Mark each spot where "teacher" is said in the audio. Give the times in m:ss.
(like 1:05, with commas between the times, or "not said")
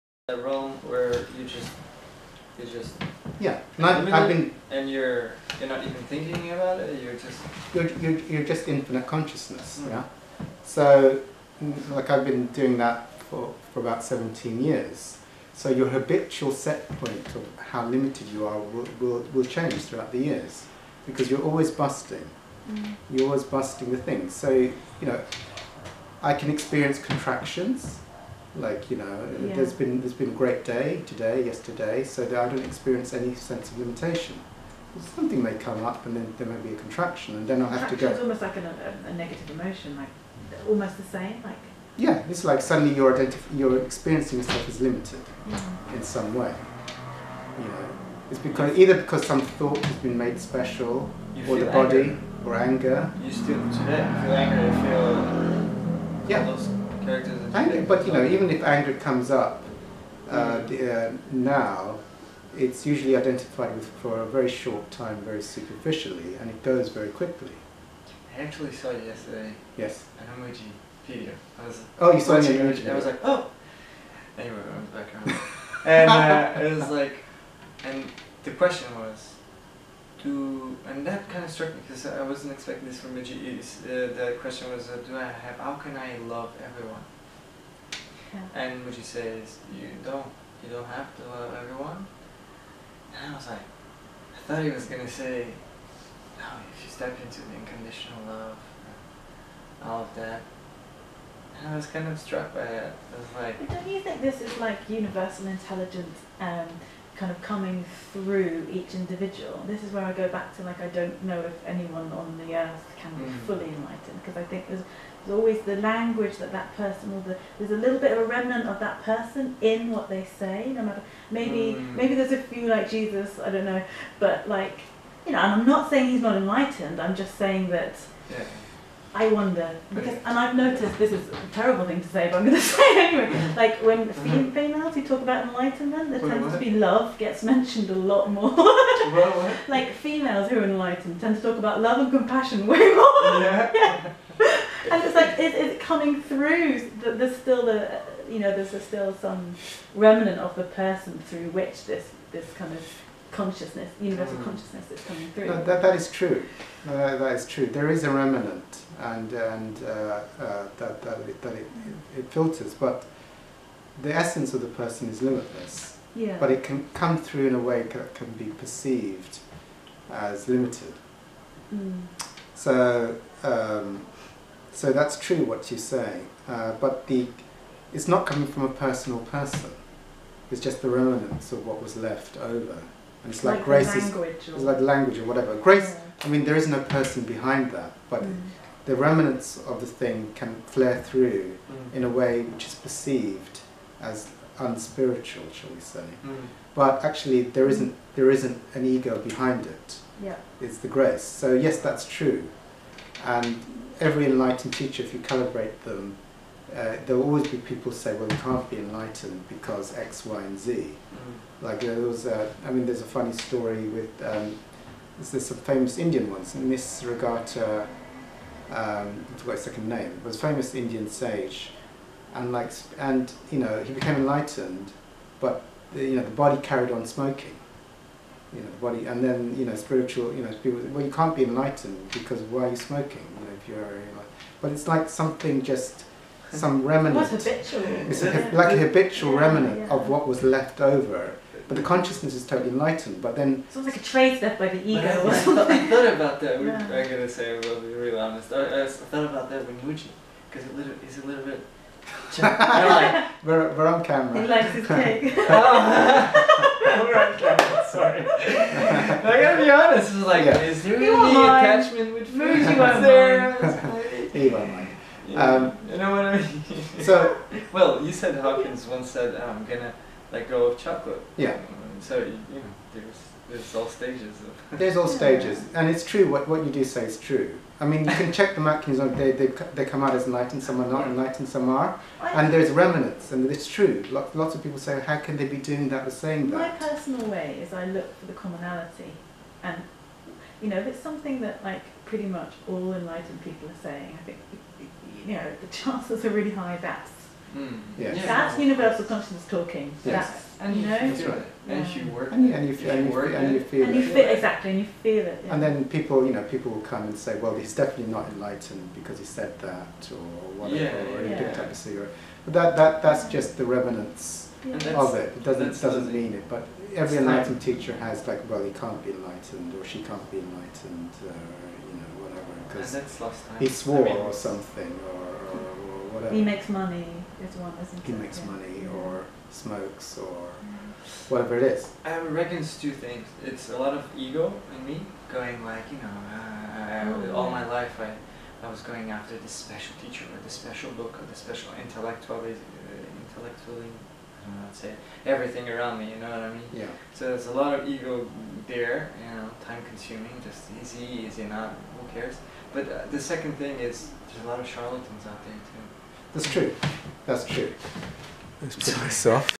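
3:24, 5:17, 5:40.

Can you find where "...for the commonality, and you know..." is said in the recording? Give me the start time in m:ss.
4:48.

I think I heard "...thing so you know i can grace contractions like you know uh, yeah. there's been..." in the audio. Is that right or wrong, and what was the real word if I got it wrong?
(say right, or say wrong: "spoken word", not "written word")
wrong: "experience", not "grace".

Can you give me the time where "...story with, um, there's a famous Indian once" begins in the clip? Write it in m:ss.
3:33.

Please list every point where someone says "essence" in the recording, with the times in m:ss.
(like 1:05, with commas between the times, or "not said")
2:44.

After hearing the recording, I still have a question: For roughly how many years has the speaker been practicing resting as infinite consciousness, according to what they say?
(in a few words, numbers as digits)
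17 years.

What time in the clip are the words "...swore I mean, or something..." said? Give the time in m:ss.
5:23.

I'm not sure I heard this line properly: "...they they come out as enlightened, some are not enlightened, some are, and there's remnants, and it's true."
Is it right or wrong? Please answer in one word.
right.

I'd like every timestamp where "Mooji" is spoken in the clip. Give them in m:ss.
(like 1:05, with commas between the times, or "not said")
1:23, 4:09.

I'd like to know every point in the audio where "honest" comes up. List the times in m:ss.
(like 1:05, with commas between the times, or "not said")
4:08, 4:19.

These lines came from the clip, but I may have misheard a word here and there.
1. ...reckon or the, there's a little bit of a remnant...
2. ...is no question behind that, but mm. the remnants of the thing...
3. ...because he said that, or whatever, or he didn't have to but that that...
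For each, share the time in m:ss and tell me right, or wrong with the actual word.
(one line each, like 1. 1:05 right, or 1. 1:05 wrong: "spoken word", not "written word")
1. 1:56 wrong: "person", not "reckon"
2. 3:06 wrong: "person", not "question"
3. 5:08 right.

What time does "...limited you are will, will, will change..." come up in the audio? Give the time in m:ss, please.
0:17.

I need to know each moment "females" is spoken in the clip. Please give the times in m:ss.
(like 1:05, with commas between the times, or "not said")
2:14, 2:19.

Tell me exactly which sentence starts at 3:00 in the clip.
It's just the remnants of what was left over.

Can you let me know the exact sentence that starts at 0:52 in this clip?
or anger you still today feel anger you feel yeah characters.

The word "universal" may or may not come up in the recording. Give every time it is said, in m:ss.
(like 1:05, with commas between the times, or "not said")
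1:44, 2:34, 4:58.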